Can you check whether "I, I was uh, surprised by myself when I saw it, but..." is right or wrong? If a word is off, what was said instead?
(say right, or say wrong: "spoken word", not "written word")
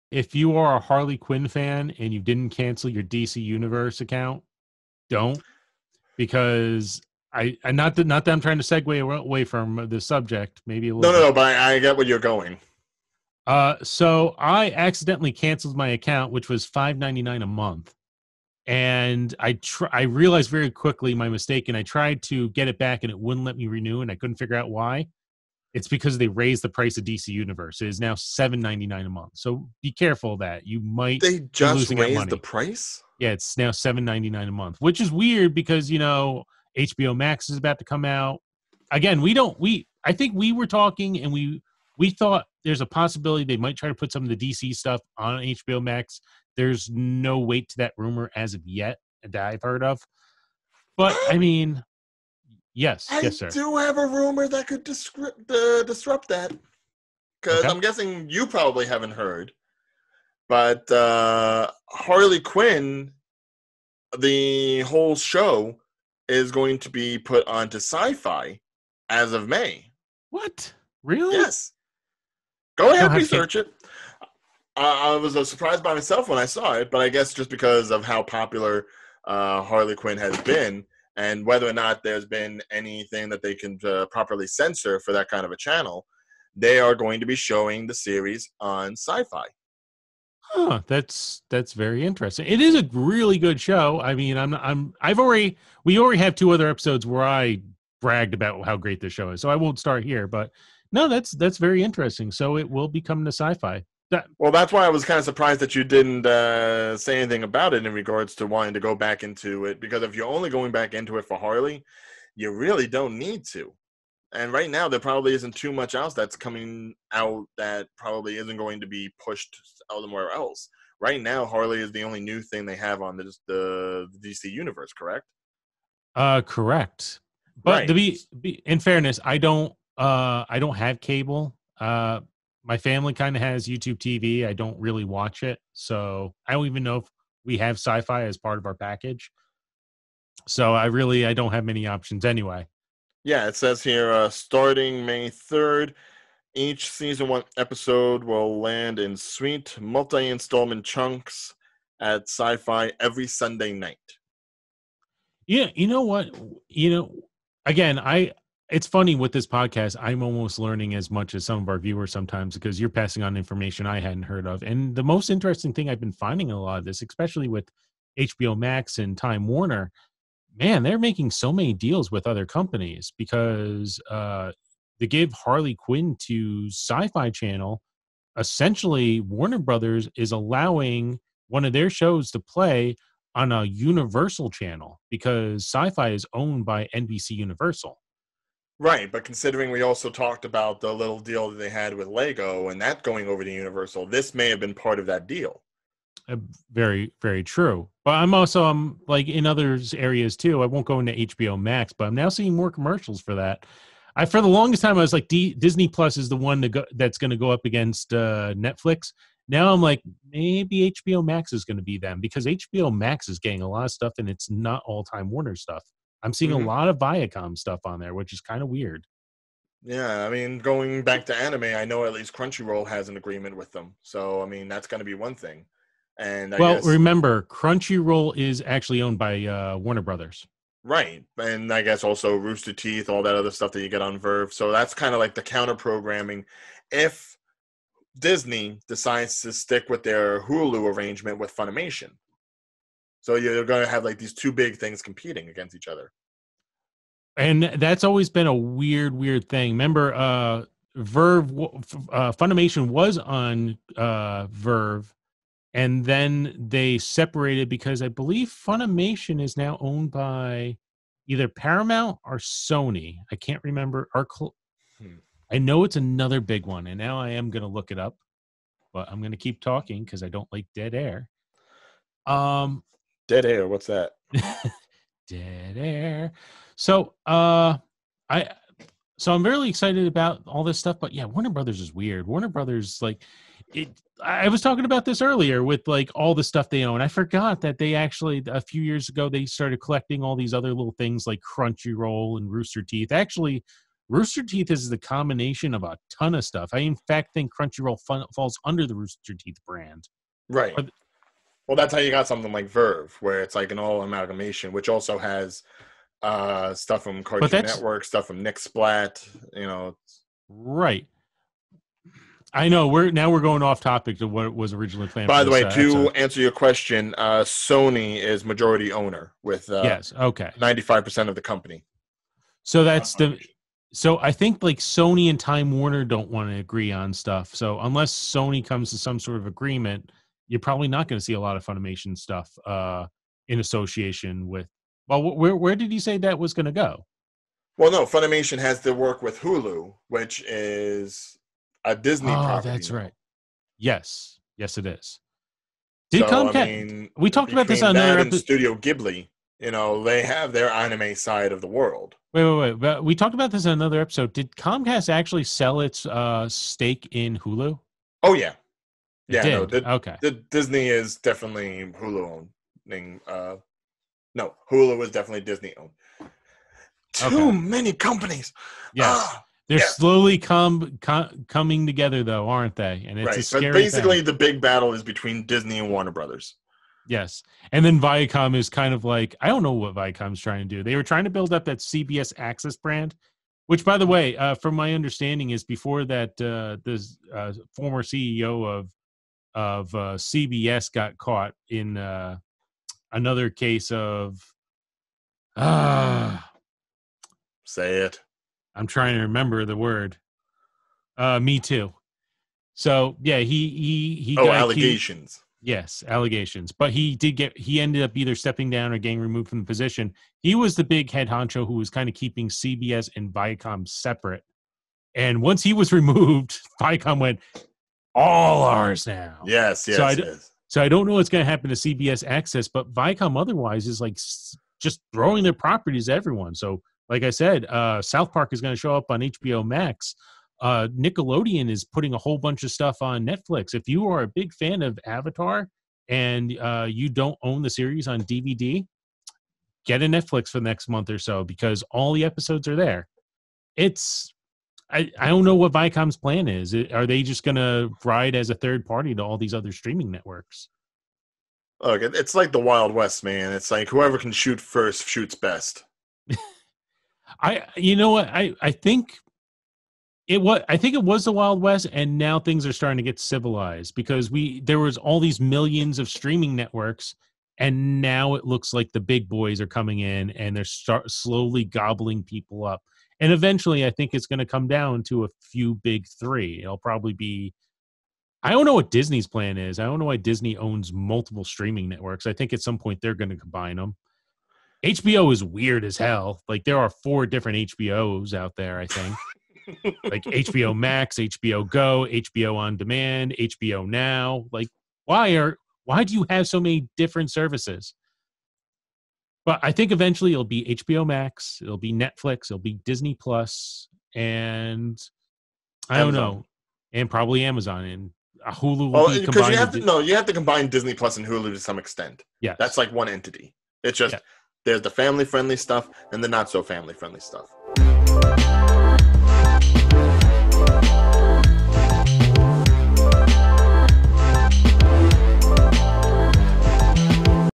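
right.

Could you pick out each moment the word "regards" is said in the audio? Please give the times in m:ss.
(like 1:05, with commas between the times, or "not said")
1:47.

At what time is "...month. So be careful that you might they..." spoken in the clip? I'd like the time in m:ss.
0:29.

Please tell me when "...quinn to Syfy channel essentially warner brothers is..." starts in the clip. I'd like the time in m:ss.
2:55.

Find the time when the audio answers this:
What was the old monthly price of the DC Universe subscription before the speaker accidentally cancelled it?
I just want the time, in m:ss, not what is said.
0:16.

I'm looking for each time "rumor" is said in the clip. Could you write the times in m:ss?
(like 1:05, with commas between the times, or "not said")
0:47, 0:54.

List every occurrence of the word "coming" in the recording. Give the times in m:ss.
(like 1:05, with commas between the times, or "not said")
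1:56, 6:11, 7:49.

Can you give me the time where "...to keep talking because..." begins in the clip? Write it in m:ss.
4:29.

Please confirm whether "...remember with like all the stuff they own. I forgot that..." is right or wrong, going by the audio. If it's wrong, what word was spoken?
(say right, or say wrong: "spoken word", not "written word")
wrong: "earlier", not "remember".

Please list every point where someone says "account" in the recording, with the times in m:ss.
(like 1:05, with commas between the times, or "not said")
0:04, 0:15.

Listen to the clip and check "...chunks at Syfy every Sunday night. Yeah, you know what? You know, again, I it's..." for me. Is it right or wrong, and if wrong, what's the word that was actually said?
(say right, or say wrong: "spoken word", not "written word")
right.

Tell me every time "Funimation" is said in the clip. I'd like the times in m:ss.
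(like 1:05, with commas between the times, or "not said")
4:01, 4:12, 4:18, 5:31, 5:38.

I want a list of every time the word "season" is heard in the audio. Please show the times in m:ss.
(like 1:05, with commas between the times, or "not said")
2:26.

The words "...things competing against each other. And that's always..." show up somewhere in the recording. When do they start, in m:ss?
4:04.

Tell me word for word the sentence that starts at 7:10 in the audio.
Uh, Nickelodeon is putting a whole bunch of stuff on Netflix.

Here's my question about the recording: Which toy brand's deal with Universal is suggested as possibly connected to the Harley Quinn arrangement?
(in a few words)
Lego.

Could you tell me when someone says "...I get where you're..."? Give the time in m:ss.
0:11.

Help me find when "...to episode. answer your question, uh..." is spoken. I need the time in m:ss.
5:15.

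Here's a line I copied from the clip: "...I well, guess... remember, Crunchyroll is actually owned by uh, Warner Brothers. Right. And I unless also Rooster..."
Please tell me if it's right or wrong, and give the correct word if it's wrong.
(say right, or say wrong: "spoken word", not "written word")
wrong: "guess", not "unless".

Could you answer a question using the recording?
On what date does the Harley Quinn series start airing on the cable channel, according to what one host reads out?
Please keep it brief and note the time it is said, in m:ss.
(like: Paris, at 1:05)
May 3, at 2:25.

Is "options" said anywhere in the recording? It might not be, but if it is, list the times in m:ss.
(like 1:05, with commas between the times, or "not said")
2:21.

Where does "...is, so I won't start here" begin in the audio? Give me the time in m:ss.
1:39.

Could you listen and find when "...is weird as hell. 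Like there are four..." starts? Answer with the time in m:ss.
8:05.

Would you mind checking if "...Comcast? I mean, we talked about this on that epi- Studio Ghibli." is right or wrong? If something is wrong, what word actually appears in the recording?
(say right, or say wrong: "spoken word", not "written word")
right.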